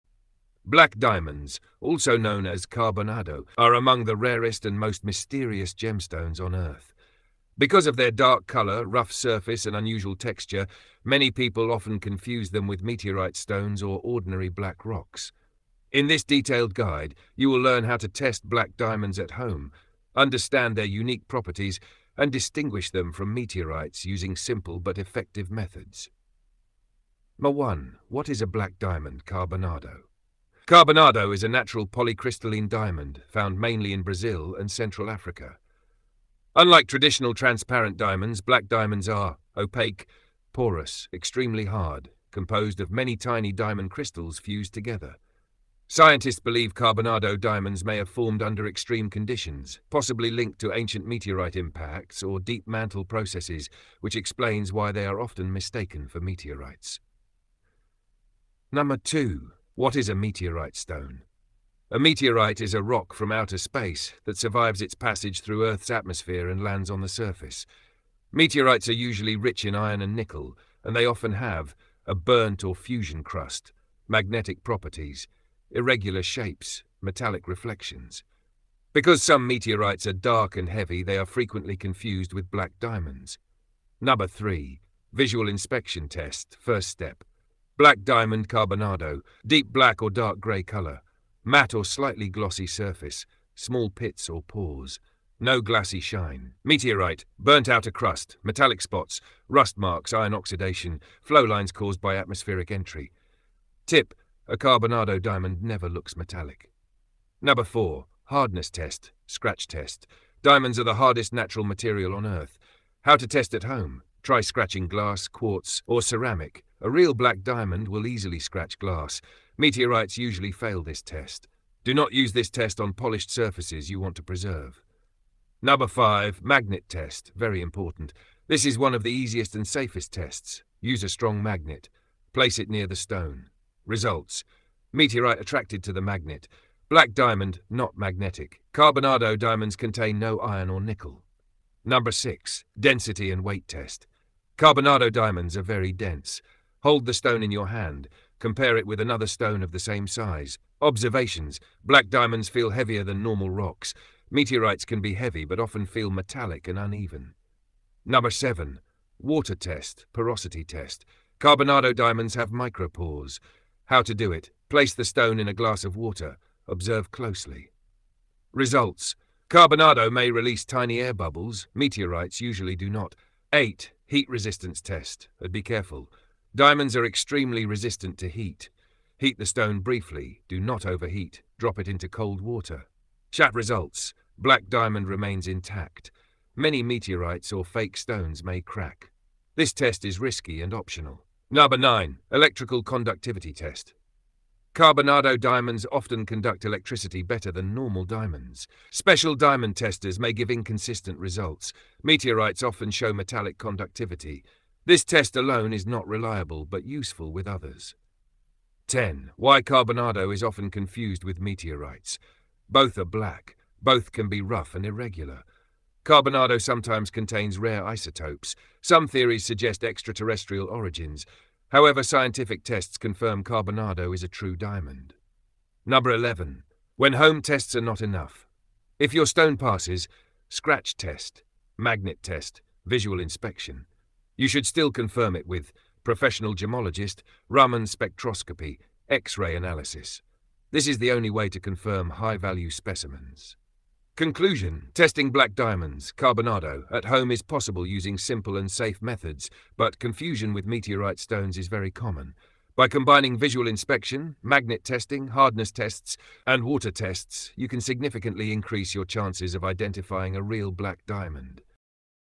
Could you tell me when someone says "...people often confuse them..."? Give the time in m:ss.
0:11.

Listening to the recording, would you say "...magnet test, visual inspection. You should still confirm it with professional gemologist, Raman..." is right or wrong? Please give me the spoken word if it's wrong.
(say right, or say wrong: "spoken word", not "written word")
right.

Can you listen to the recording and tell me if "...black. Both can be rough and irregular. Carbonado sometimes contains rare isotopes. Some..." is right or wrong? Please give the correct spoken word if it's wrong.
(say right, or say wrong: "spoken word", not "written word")
right.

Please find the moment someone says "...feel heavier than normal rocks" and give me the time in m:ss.
2:32.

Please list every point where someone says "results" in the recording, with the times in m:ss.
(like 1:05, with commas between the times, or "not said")
2:13, 2:48, 3:03, 3:21.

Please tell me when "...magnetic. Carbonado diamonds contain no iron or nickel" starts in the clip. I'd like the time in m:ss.
2:17.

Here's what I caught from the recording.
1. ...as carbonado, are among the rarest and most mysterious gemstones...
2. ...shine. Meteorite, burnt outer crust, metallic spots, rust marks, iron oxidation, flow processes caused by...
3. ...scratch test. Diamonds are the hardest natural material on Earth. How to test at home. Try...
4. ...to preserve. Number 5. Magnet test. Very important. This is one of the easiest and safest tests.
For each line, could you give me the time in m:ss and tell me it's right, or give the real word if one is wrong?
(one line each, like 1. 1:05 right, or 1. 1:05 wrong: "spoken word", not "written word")
1. 0:02 right
2. 1:36 wrong: "lines", not "processes"
3. 1:49 right
4. 2:04 right.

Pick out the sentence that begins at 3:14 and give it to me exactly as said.
Carbonado diamonds often conduct electricity better than normal diamonds.